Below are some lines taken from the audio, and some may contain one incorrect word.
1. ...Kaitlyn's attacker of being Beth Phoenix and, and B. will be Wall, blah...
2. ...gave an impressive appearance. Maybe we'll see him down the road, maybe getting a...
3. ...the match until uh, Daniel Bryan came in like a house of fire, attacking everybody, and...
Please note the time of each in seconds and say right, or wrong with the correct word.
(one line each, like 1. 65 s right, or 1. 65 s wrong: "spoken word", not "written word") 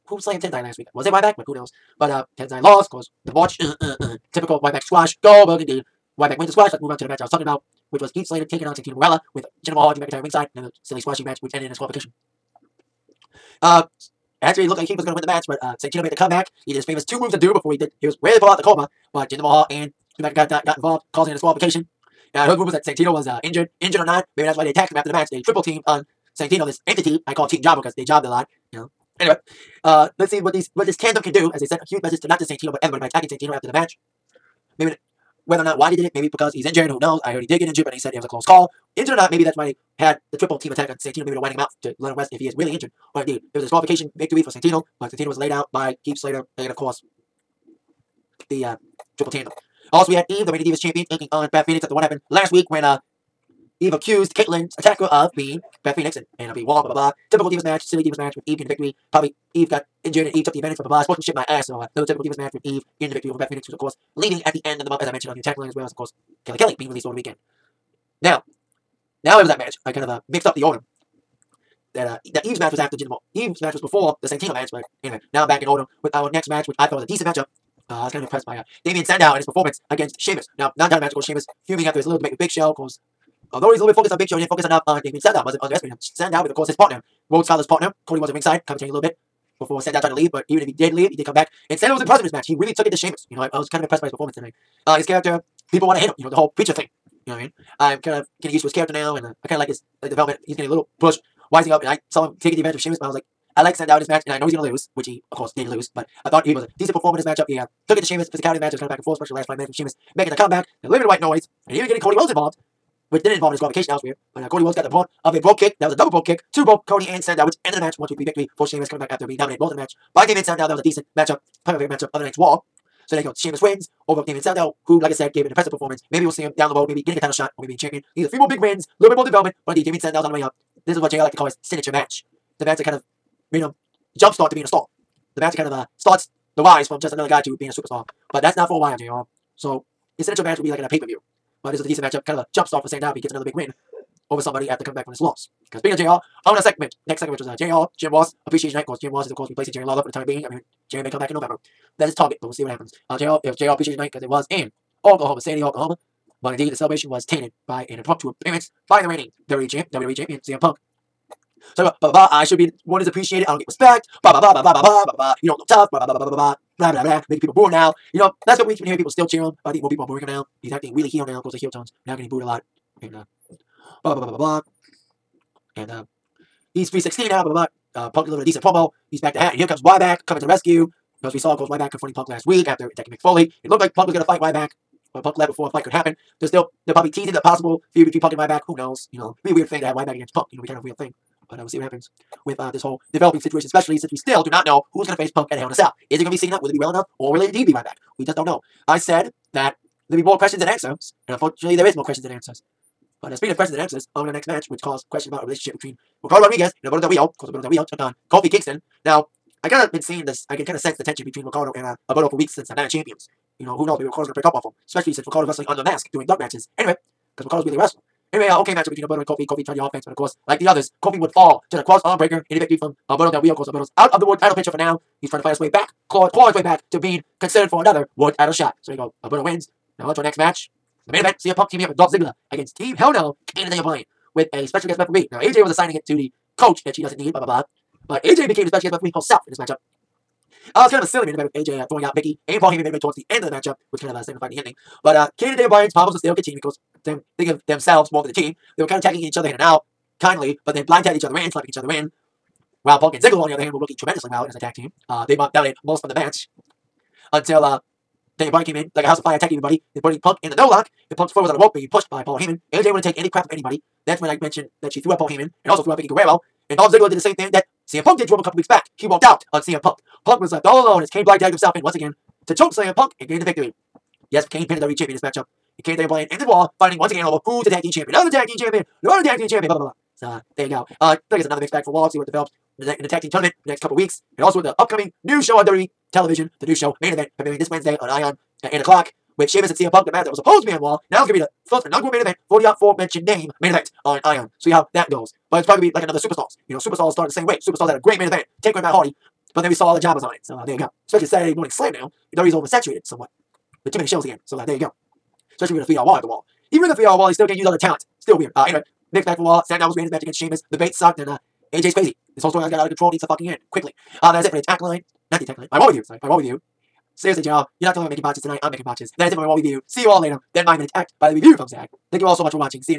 1. 54 s right
2. 125 s wrong: "performance", not "appearance"
3. 256 s right.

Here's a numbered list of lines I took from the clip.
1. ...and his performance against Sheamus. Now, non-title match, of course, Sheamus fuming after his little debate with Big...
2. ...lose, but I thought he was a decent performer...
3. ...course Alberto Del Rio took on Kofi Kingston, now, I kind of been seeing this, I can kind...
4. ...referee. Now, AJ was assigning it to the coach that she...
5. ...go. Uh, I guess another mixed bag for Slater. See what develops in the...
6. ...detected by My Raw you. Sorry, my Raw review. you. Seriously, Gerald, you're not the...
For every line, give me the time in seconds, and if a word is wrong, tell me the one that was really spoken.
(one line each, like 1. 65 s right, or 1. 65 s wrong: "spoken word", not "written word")
1. 79 s right
2. 105 s right
3. 207 s right
4. 234 s right
5. 280 s wrong: "Wall", not "Slater"
6. 315 s right.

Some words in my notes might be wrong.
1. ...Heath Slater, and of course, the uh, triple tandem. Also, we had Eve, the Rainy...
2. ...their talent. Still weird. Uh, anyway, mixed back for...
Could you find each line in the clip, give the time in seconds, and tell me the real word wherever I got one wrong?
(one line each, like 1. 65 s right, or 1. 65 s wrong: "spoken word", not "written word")
1. 46 s right
2. 307 s right.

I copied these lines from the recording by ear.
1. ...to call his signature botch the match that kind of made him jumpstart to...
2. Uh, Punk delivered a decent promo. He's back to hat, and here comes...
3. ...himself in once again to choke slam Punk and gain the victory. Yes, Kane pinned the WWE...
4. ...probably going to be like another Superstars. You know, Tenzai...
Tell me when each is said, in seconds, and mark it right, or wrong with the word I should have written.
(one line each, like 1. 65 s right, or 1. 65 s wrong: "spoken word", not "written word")
1. 131 s wrong: "match", not "botch"
2. 177 s right
3. 271 s right
4. 295 s wrong: "Superstars", not "Tenzai".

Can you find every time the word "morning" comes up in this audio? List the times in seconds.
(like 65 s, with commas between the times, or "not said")
301 s.